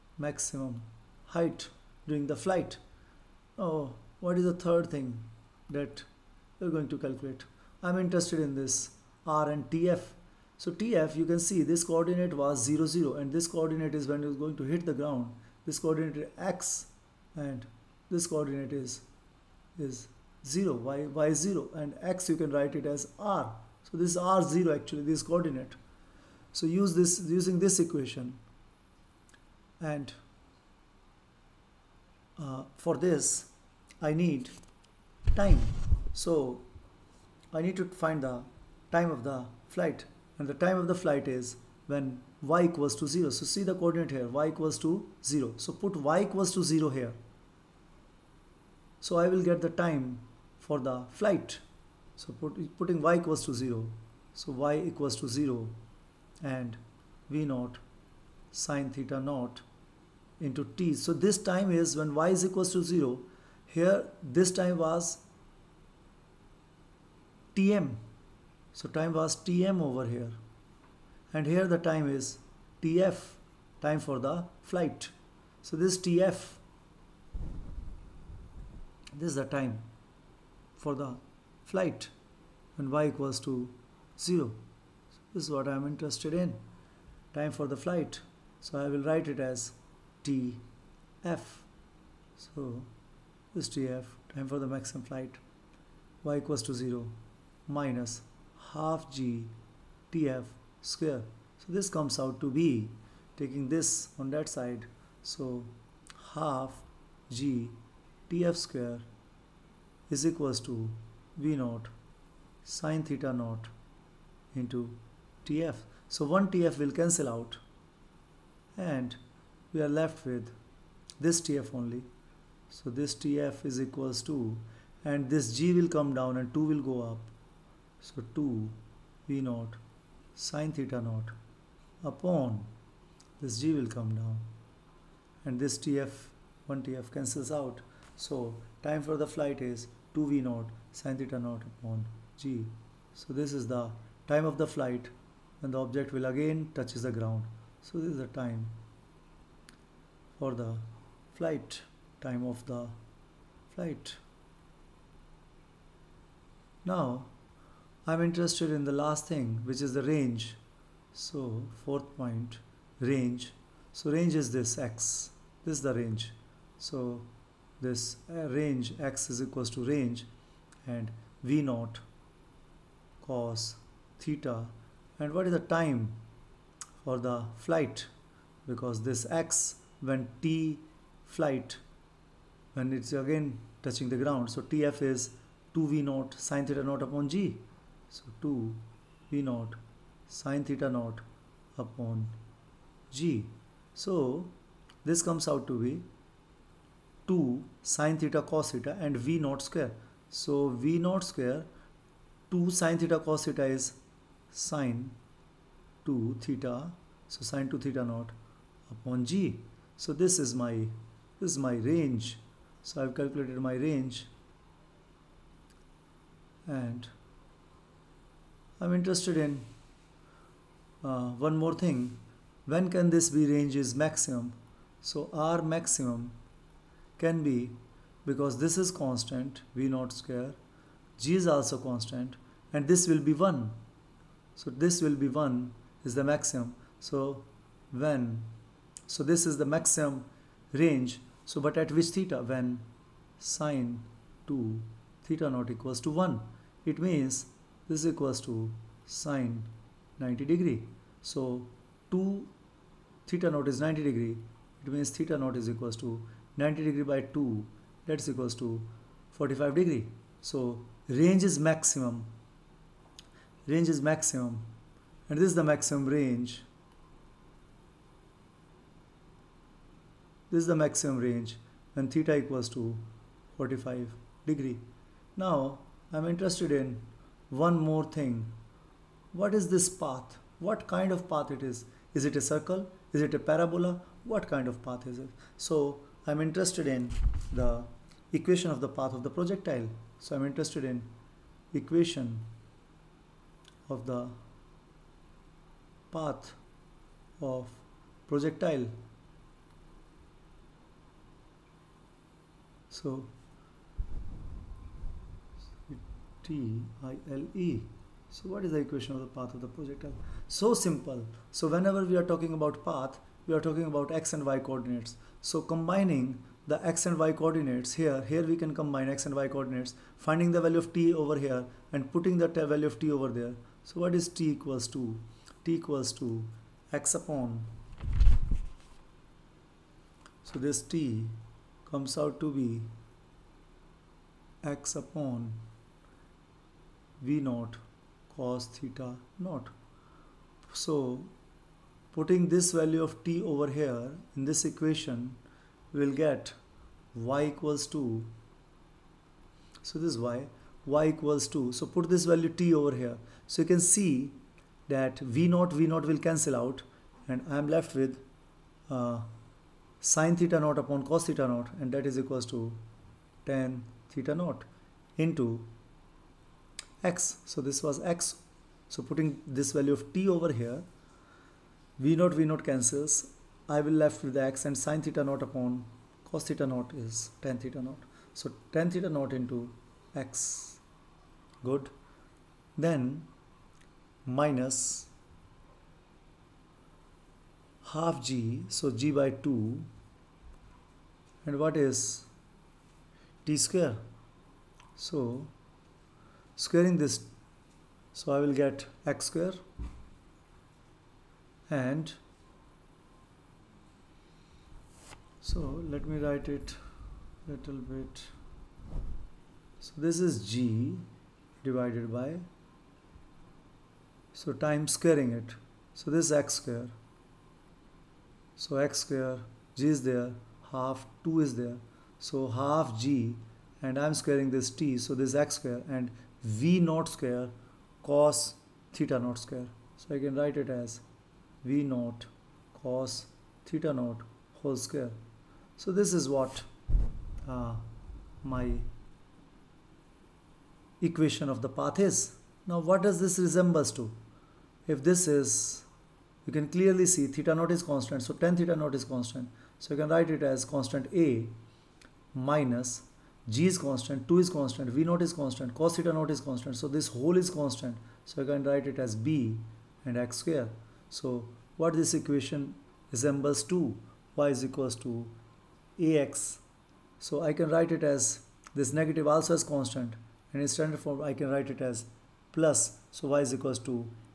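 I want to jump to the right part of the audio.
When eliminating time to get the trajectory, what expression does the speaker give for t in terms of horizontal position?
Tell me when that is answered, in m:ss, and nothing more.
5:34.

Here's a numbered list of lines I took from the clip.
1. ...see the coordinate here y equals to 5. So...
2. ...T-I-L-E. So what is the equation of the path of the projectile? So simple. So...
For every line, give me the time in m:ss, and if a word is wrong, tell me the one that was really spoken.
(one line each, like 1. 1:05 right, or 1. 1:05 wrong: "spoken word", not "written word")
1. 0:43 wrong: "0", not "5"
2. 5:06 right.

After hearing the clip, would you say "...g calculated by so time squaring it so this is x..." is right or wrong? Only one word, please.
wrong.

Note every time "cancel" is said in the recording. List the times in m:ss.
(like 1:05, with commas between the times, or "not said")
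1:56, 2:17, 5:56, 6:12.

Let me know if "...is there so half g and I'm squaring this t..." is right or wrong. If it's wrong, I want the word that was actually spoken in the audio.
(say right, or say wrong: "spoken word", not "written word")
right.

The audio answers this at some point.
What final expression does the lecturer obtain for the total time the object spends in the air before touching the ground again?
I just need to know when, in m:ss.
2:18.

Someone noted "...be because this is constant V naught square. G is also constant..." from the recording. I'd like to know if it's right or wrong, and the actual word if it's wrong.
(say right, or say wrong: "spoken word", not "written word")
right.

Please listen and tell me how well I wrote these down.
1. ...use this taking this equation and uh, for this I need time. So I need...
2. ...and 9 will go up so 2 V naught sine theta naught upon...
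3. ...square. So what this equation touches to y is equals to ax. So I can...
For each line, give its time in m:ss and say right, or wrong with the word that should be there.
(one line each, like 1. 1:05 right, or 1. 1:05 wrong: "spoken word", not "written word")
1. 0:26 wrong: "using", not "taking"
2. 2:06 wrong: "2", not "9"
3. 7:40 wrong: "resembles", not "touches".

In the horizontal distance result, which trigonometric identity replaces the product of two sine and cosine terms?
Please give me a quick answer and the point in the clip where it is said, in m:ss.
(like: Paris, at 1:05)
sine 2 theta, at 3:22.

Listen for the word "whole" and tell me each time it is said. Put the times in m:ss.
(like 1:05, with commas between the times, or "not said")
7:14, 7:37.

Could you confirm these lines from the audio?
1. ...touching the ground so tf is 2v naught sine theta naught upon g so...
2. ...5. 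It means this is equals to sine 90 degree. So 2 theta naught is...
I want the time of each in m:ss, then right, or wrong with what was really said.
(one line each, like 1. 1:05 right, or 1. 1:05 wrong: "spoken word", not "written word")
1. 3:03 right
2. 4:06 wrong: "1", not "5".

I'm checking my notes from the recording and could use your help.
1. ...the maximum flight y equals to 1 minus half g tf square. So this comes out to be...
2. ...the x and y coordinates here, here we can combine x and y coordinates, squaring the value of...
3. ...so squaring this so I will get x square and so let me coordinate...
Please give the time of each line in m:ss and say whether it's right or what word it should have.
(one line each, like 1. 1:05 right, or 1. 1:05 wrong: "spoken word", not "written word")
1. 1:34 wrong: "0", not "1"
2. 5:16 wrong: "finding", not "squaring"
3. 6:35 wrong: "write", not "coordinate".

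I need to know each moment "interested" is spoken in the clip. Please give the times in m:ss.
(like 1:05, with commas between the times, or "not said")
0:07, 1:25, 2:38, 3:38, 4:36, 4:46, 4:50.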